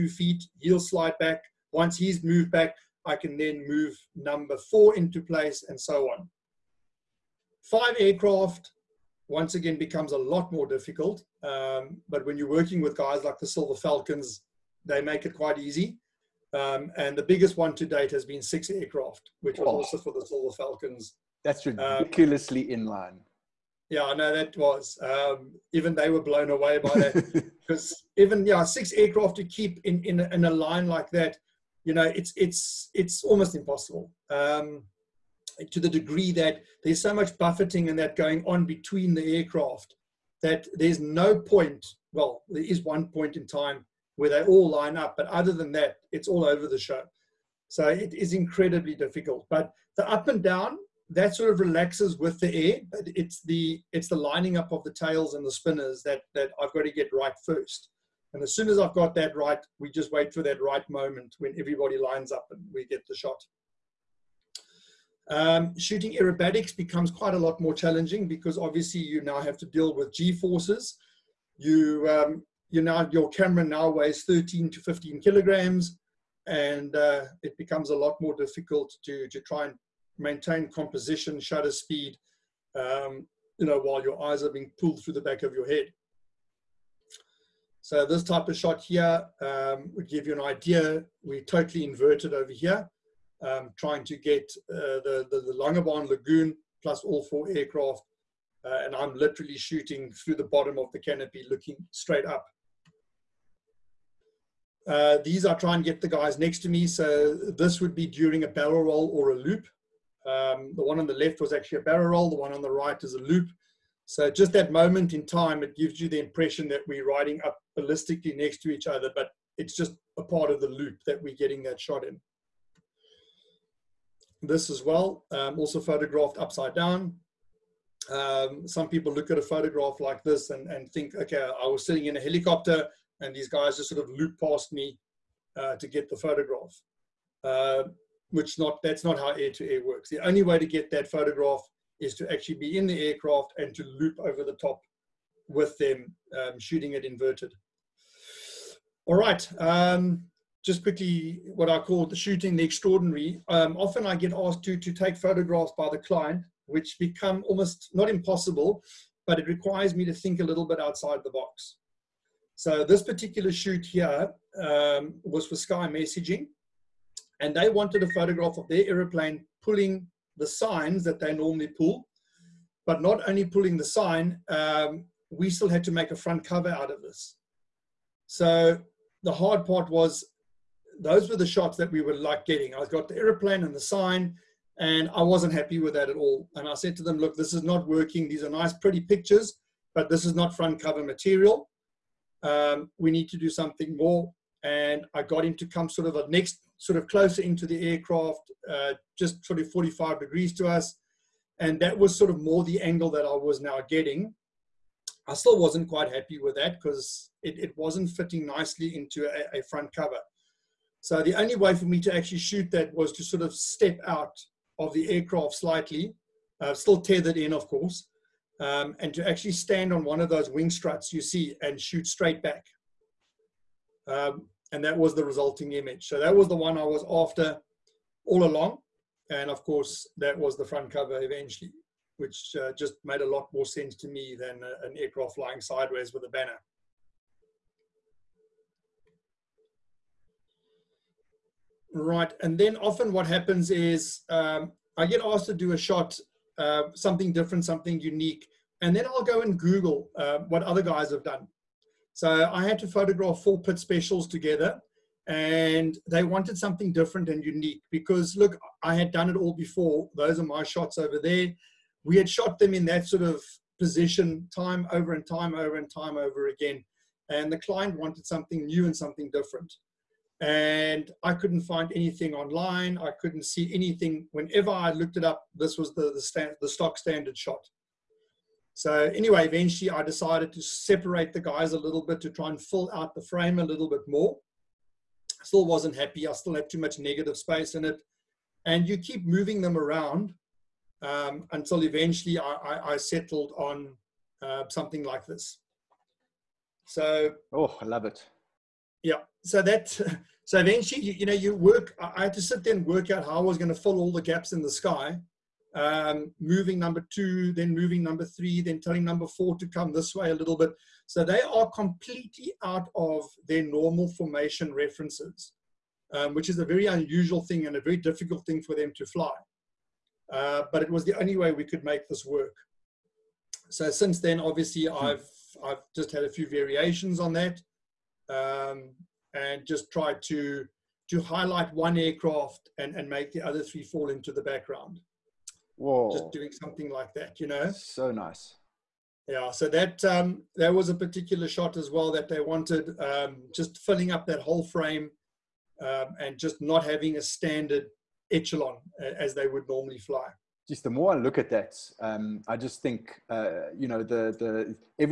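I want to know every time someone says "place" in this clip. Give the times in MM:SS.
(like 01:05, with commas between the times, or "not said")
00:05.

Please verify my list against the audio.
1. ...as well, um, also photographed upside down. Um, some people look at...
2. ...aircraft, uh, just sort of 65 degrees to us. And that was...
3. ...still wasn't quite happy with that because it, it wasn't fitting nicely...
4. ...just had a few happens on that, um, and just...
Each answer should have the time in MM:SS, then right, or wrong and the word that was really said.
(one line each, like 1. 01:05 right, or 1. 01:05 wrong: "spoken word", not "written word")
1. 02:04 right
2. 03:17 wrong: "45", not "65"
3. 03:25 right
4. 05:25 wrong: "variations", not "happens".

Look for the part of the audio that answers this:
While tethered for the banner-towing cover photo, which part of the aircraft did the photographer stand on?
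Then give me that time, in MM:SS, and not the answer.
03:40.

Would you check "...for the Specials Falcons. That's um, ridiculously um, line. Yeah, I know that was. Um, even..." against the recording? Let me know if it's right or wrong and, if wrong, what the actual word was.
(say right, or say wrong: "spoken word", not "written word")
wrong: "Silver", not "Specials".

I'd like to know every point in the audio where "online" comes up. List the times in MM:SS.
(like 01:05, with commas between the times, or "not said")
04:32.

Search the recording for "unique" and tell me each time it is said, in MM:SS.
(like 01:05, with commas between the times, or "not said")
04:07, 04:17.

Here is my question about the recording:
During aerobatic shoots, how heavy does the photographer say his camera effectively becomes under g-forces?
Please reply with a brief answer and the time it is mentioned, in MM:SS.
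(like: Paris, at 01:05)
13 to 15 kilograms, at 01:14.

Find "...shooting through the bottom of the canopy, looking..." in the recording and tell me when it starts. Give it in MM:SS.
01:39.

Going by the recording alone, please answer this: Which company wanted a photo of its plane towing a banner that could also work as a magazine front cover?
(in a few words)
Sky Messaging.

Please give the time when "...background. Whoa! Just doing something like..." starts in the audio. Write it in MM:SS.
05:34.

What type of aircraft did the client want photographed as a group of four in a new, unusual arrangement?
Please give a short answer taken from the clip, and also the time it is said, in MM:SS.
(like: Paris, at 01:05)
Pitts Specials, at 04:13.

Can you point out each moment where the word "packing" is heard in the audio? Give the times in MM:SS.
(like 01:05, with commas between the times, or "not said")
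not said.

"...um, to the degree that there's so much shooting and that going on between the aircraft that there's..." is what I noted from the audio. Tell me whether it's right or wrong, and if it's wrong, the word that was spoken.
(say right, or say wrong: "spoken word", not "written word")
wrong: "buffeting", not "shooting".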